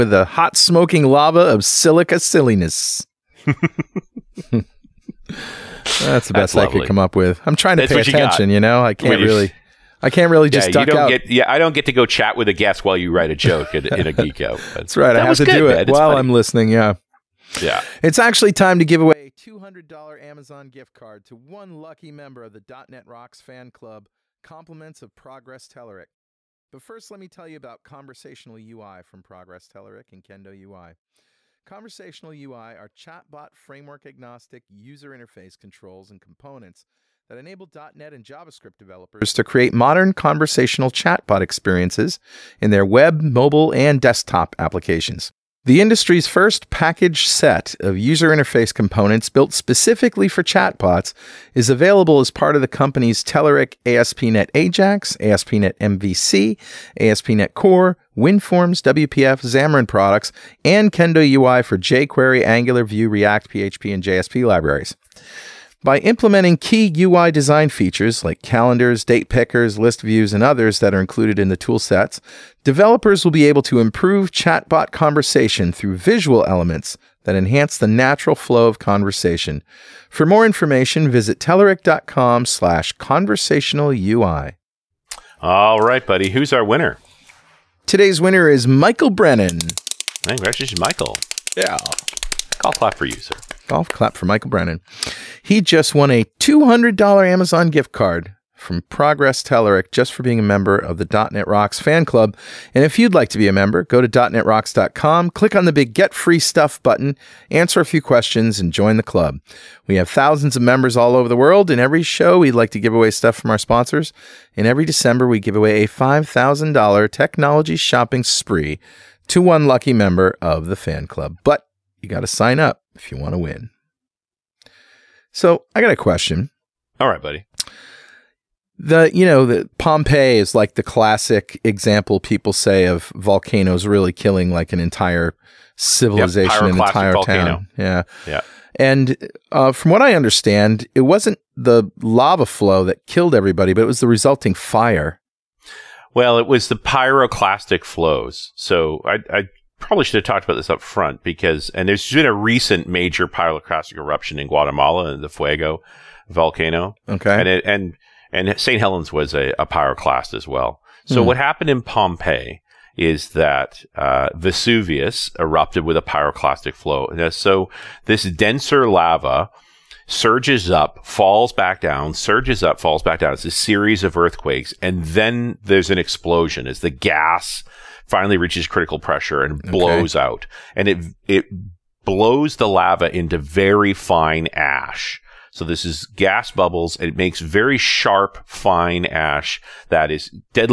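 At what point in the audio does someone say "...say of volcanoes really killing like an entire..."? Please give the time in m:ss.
2:12.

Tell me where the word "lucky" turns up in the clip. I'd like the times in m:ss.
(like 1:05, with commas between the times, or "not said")
0:21, 1:59.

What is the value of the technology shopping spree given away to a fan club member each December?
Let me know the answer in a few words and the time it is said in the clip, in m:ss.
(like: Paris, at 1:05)
$5,000, at 1:55.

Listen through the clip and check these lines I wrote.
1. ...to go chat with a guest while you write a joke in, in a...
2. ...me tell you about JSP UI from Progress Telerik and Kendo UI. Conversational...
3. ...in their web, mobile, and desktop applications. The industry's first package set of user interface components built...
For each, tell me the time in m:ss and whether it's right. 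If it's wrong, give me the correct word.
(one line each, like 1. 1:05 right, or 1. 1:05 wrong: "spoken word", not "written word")
1. 0:11 right
2. 0:27 wrong: "Conversational", not "JSP"
3. 0:42 right.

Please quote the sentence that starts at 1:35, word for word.
He just won a $200 Amazon gift card from Progress Telerik just for being a member of the .NET Rocks fan club.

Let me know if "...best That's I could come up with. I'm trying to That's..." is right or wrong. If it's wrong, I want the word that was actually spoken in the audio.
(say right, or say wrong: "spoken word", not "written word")
right.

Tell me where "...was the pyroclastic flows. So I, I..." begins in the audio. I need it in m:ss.
2:26.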